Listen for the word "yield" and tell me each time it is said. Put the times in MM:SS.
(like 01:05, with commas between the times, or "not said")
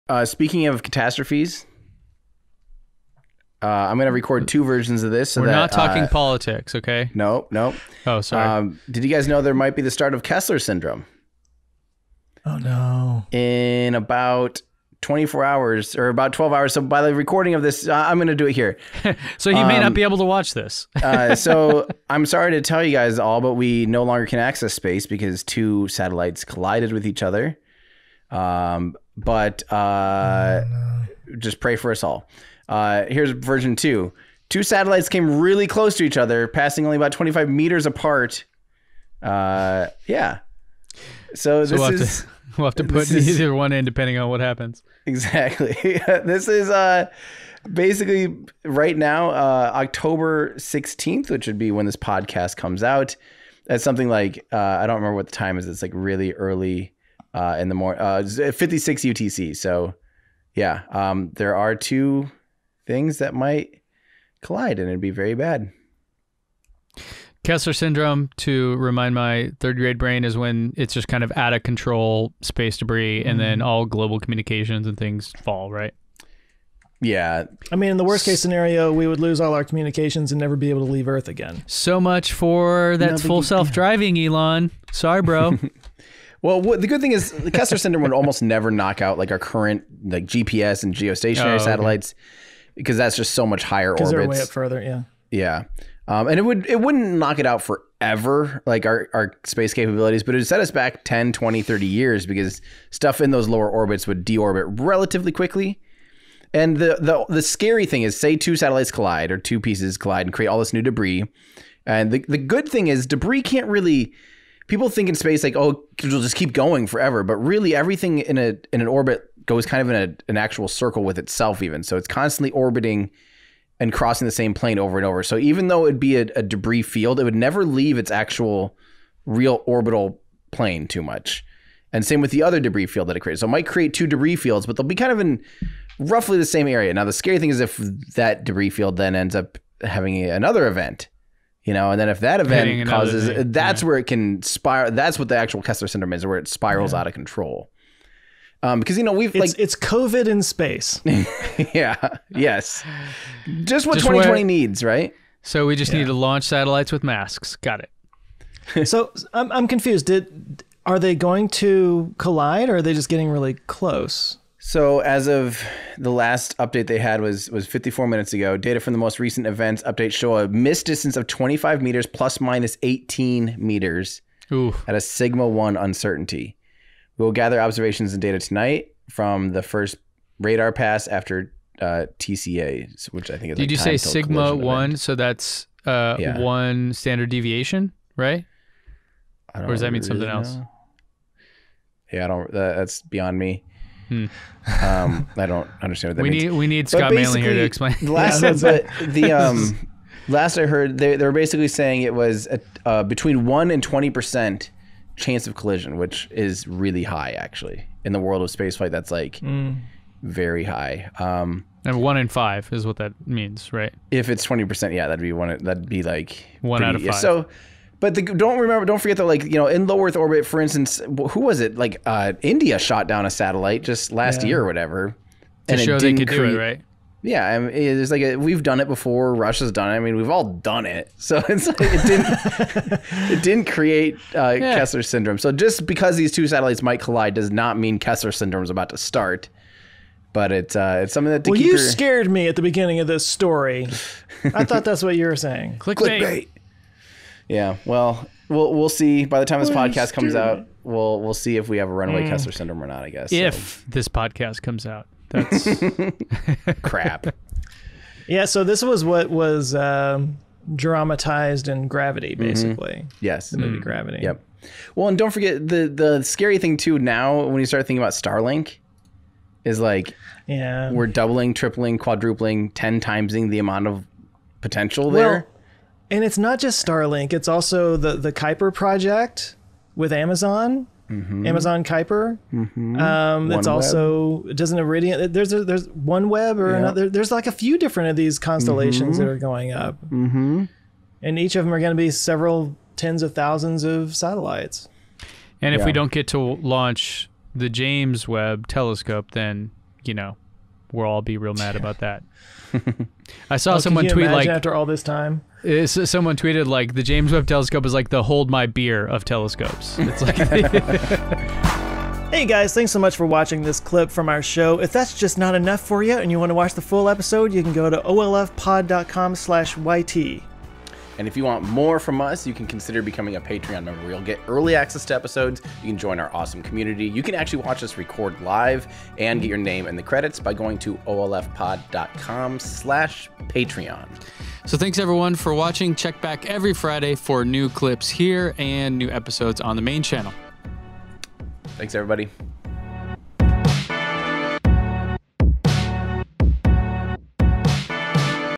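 not said.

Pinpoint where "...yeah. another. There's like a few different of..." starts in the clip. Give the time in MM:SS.
04:46.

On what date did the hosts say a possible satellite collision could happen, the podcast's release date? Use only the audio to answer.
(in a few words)
October 16th.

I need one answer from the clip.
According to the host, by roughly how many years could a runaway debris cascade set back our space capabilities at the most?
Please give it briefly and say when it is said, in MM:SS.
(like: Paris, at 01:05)
30 years, at 01:41.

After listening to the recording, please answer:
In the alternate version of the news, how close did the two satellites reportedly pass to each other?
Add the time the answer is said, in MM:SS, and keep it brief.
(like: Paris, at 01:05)
25 meters, at 00:36.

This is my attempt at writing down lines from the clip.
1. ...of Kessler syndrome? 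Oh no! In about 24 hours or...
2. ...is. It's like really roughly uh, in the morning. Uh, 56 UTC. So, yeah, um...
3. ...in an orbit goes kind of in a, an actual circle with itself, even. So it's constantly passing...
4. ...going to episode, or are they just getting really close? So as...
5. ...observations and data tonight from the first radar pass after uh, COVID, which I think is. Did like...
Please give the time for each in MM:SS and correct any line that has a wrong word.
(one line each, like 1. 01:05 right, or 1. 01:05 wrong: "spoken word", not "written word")
1. 00:10 right
2. 00:55 wrong: "early", not "roughly"
3. 01:58 wrong: "orbiting", not "passing"
4. 02:41 wrong: "collide", not "episode"
5. 02:57 wrong: "TCA", not "COVID".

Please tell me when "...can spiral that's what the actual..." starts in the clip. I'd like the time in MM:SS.
02:24.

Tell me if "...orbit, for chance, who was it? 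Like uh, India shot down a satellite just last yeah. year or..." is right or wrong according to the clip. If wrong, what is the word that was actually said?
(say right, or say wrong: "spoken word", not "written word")
wrong: "instance", not "chance".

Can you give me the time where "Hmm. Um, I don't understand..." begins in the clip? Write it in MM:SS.
03:14.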